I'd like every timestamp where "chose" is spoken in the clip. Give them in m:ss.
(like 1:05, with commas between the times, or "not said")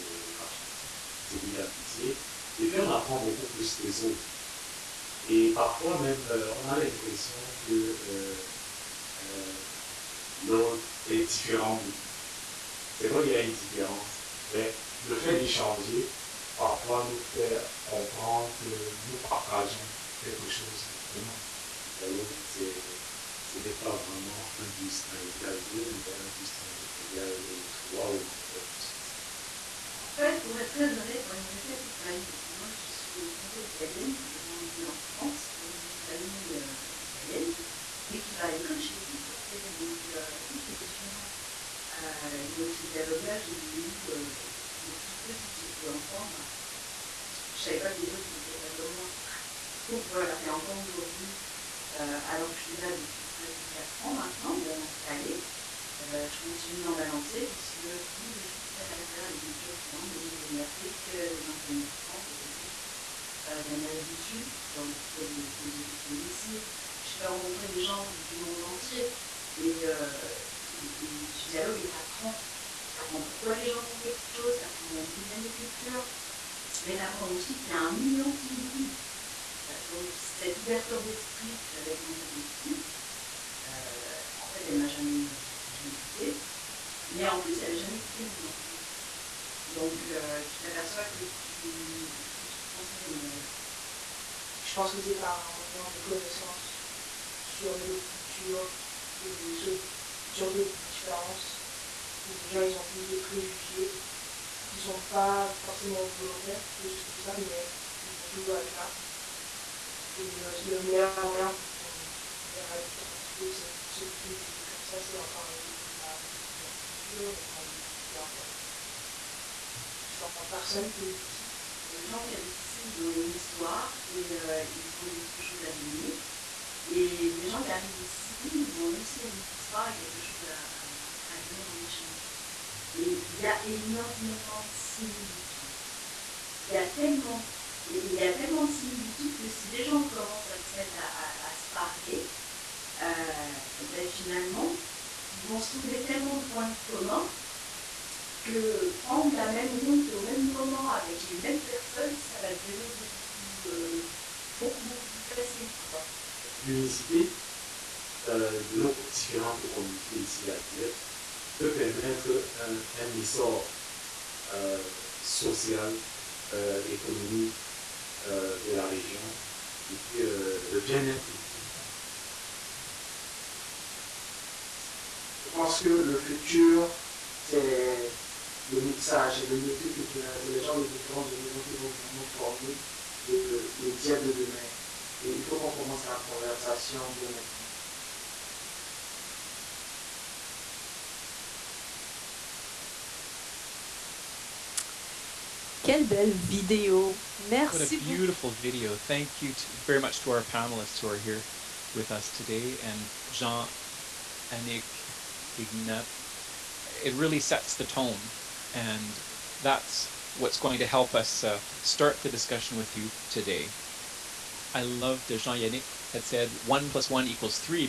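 0:20, 1:14, 2:05, 2:10.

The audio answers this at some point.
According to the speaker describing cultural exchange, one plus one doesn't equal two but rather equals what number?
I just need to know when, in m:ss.
0:26.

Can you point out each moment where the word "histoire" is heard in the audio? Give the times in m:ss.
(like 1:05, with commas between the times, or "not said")
2:03, 2:09.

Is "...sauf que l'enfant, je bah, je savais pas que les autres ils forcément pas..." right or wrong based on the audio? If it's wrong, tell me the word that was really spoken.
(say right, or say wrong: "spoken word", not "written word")
wrong: "étaient", not "forcément".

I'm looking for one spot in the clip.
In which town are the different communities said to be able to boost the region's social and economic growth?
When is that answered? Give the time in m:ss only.
2:40.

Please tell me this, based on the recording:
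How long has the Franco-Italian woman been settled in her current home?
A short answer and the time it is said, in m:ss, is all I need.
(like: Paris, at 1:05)
almost 4 years, at 0:53.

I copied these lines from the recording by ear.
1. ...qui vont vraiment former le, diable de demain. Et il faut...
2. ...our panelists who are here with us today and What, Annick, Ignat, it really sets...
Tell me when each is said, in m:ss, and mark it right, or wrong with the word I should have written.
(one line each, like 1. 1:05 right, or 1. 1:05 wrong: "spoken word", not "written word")
1. 3:01 right
2. 3:20 wrong: "Jean", not "What".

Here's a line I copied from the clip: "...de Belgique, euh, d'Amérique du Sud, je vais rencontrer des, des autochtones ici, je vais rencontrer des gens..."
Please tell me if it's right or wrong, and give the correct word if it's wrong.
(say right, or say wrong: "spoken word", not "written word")
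right.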